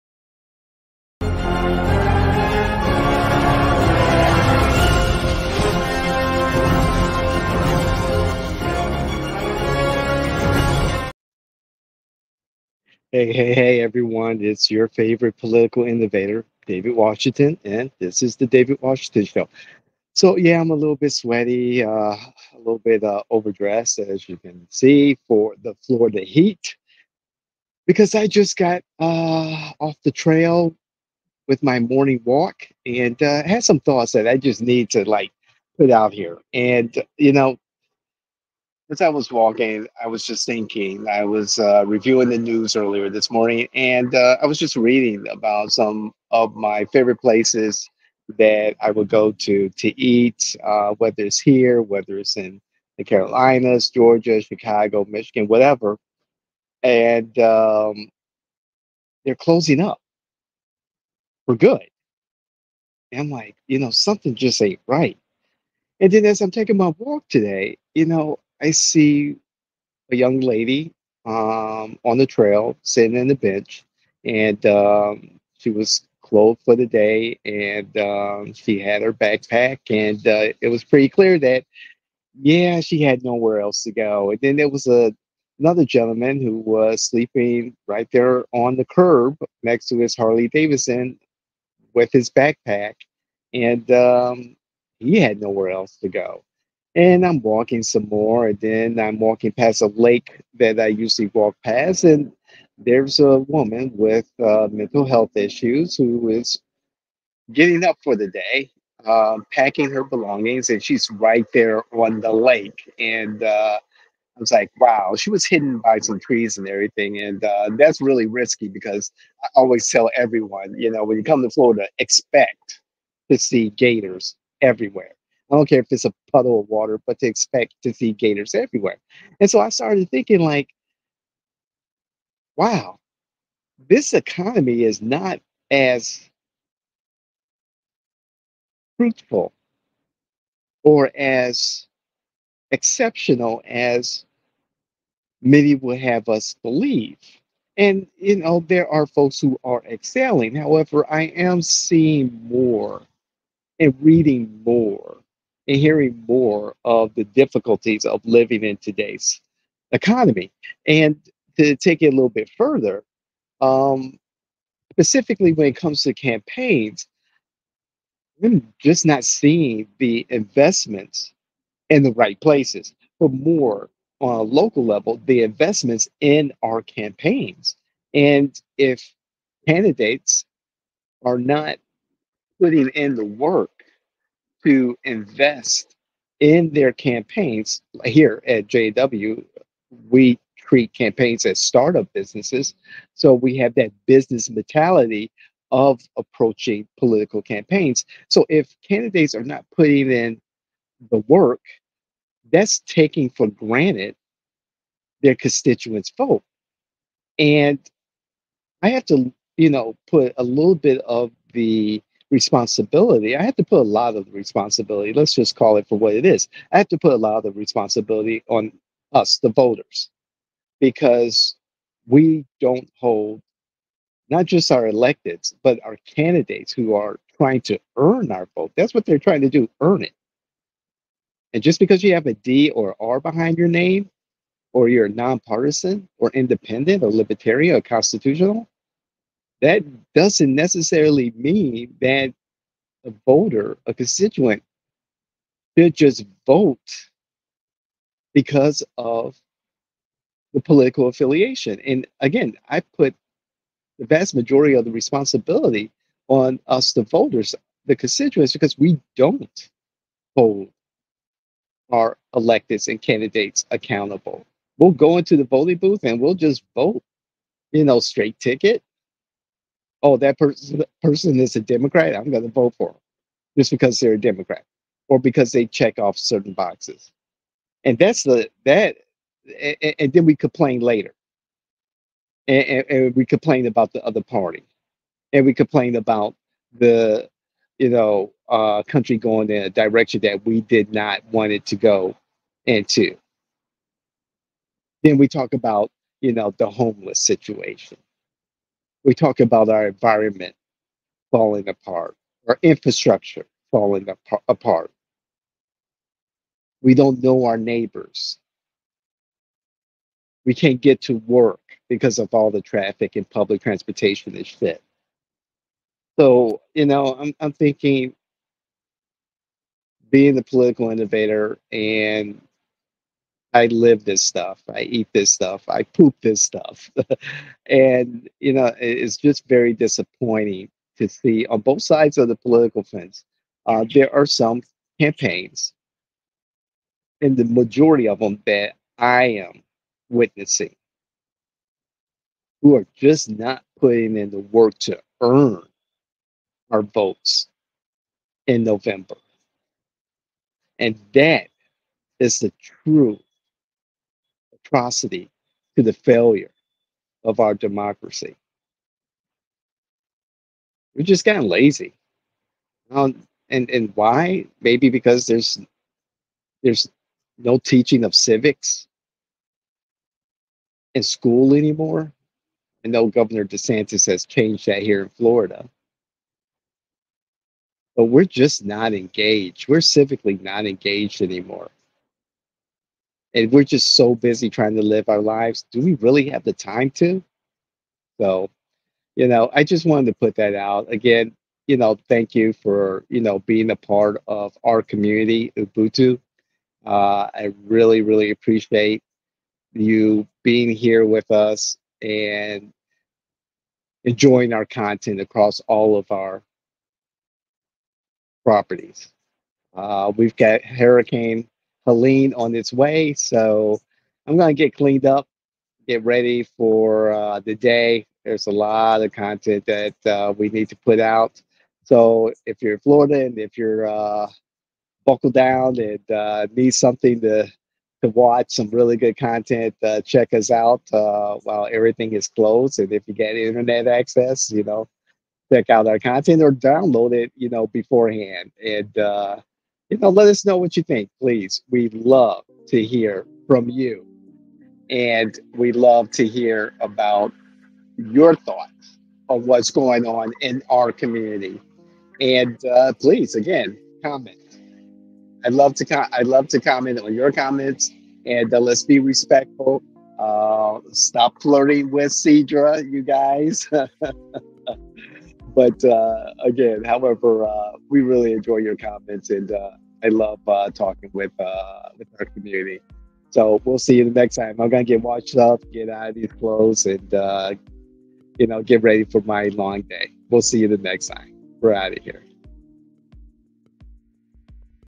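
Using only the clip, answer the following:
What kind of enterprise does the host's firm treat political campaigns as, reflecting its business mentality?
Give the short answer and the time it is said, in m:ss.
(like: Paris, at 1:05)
Startup businesses, at 3:11.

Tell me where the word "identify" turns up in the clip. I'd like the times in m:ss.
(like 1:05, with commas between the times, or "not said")
not said.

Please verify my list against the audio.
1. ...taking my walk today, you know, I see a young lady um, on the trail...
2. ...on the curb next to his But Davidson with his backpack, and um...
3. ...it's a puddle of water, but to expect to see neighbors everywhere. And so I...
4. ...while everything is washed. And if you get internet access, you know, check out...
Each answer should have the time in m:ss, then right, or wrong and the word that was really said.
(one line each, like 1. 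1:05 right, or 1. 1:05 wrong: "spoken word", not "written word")
1. 1:06 right
2. 1:28 wrong: "Harley", not "But"
3. 2:05 wrong: "gators", not "neighbors"
4. 7:10 wrong: "closed", not "washed".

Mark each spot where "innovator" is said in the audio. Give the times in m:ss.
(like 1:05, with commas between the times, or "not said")
0:15, 5:20.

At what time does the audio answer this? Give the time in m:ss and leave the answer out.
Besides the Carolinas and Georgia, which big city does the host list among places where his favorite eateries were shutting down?
0:54.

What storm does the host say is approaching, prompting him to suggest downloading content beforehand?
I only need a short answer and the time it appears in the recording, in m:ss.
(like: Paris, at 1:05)
Hurricane Helene, at 6:50.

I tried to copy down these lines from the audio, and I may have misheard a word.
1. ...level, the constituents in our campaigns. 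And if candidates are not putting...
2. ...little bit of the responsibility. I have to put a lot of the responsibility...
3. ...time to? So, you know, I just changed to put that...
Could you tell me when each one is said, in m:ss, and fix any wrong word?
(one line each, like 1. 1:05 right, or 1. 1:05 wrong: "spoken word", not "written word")
1. 2:54 wrong: "investments", not "constituents"
2. 3:30 right
3. 6:26 wrong: "wanted", not "changed".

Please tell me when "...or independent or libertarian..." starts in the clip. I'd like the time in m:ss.
3:56.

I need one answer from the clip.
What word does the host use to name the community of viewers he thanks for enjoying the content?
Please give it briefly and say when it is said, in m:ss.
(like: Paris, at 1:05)
Ubuntu, at 6:35.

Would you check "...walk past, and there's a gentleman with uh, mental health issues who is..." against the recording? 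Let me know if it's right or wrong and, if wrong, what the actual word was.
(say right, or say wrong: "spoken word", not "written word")
wrong: "woman", not "gentleman".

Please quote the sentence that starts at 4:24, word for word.
We'll go into the voting booth and we'll just vote, you know, straight ticket.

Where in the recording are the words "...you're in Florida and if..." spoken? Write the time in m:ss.
7:02.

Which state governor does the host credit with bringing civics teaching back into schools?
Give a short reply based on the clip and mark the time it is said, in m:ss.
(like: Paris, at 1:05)
Governor DeSantis, at 6:13.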